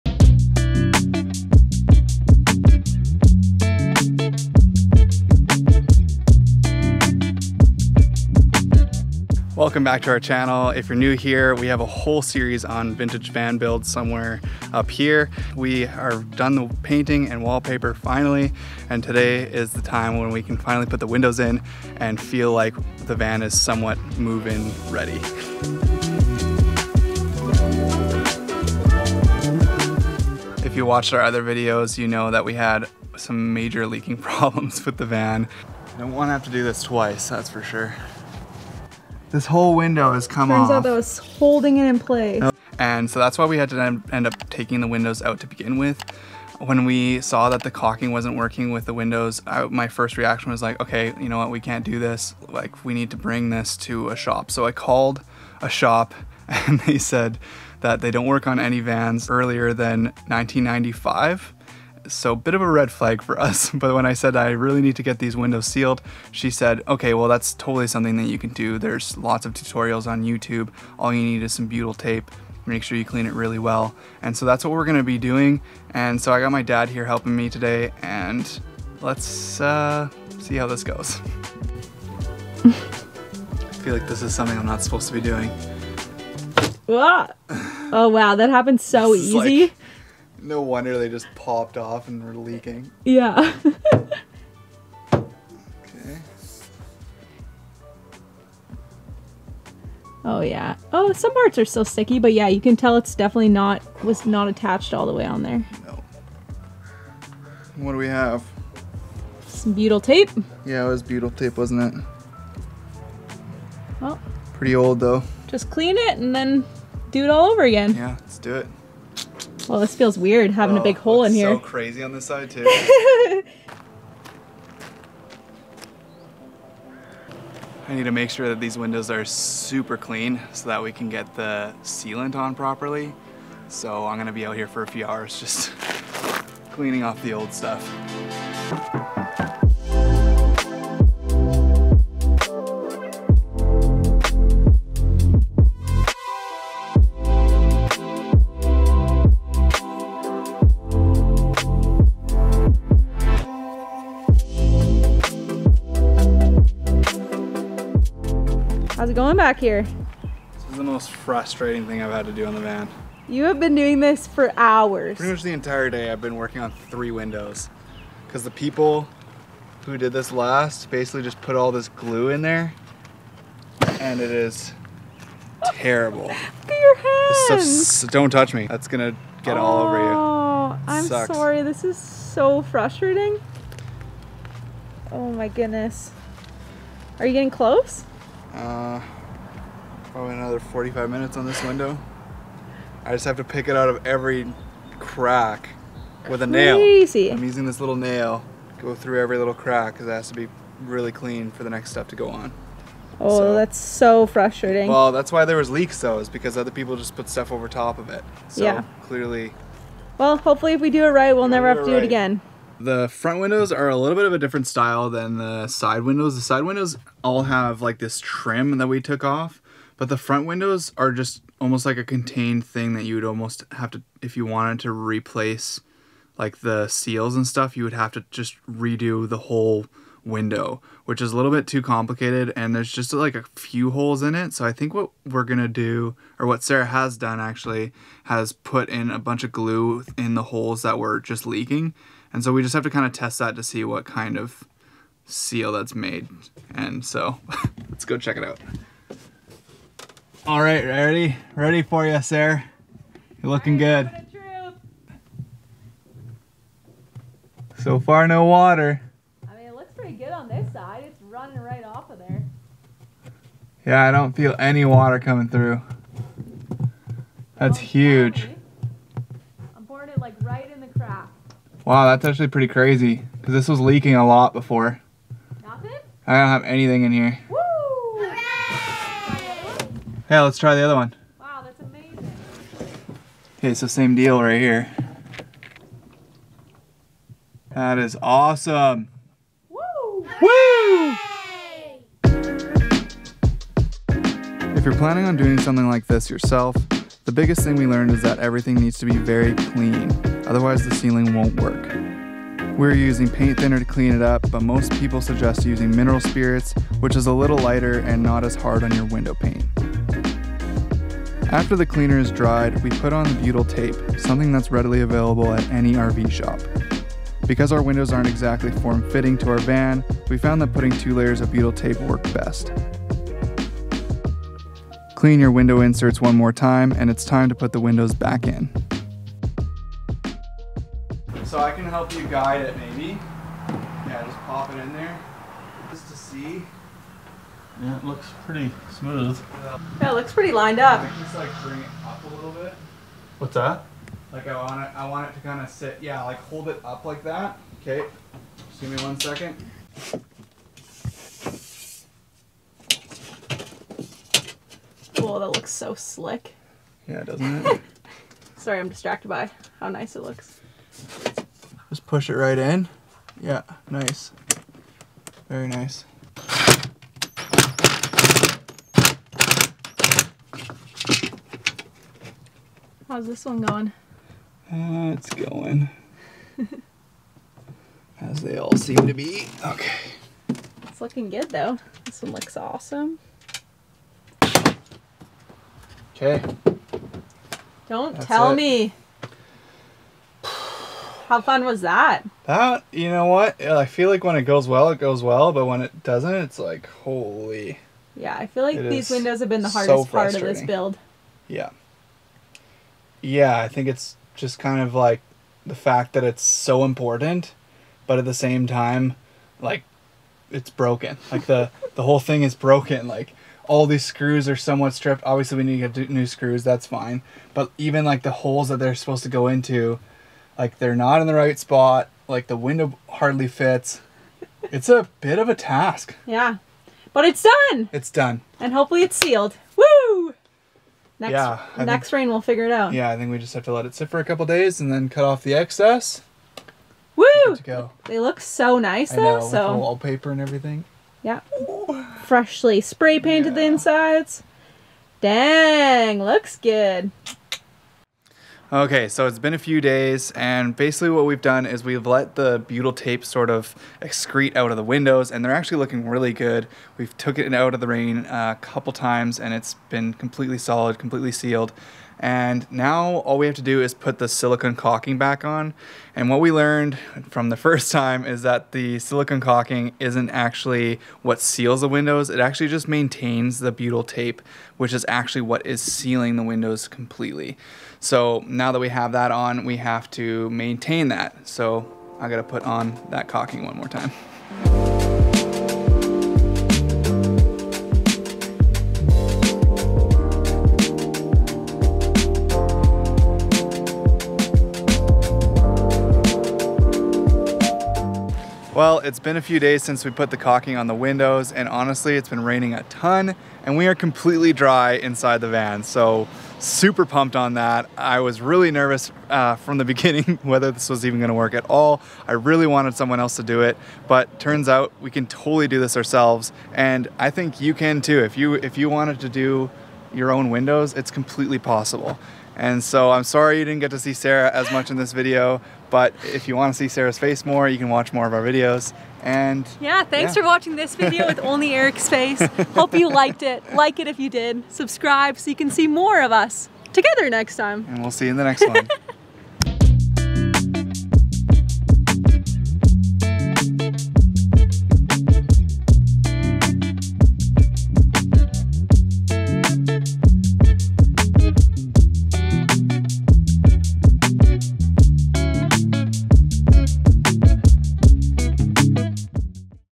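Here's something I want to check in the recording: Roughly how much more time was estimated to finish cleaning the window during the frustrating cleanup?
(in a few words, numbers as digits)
45 minutes.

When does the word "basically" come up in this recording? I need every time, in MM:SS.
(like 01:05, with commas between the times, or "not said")
02:50, 07:30.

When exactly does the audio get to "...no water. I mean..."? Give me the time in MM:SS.
04:18.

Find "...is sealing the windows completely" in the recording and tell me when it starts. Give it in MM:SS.
07:55.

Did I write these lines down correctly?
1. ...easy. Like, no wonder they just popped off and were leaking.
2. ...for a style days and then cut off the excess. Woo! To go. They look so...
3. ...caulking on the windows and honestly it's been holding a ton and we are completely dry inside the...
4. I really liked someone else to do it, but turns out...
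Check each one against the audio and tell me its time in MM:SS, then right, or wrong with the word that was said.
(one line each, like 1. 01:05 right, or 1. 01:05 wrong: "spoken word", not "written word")
1. 01:29 right
2. 07:14 wrong: "couple", not "style"
3. 08:20 wrong: "raining", not "holding"
4. 08:32 wrong: "wanted", not "liked".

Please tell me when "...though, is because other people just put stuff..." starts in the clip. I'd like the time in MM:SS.
03:26.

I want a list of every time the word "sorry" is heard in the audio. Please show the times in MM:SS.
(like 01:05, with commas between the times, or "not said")
03:01, 05:58, 08:43.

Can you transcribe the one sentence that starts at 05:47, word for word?
Okay, just give me one second.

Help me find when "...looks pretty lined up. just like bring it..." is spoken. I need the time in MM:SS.
05:40.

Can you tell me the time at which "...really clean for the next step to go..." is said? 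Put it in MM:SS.
03:20.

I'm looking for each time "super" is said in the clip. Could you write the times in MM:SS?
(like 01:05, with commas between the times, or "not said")
02:09, 08:26.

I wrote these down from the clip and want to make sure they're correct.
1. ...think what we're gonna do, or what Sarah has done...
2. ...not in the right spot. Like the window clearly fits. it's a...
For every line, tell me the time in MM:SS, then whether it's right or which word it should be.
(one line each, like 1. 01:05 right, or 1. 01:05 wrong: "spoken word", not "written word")
1. 03:54 right
2. 07:00 wrong: "hardly", not "clearly".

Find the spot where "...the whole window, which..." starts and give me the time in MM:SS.
03:49.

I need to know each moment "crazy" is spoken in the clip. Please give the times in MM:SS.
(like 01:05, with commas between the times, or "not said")
02:01, 03:16, 04:32.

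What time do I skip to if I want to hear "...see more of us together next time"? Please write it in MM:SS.
08:55.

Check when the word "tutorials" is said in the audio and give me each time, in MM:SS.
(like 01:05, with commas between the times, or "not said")
01:09.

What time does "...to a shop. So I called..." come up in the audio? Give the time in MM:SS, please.
00:53.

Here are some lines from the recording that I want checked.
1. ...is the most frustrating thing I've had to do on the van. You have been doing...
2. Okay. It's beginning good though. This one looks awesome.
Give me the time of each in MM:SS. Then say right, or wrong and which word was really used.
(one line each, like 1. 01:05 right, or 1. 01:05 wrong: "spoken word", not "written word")
1. 02:40 right
2. 06:19 wrong: "looking", not "beginning".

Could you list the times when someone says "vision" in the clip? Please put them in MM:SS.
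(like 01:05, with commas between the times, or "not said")
not said.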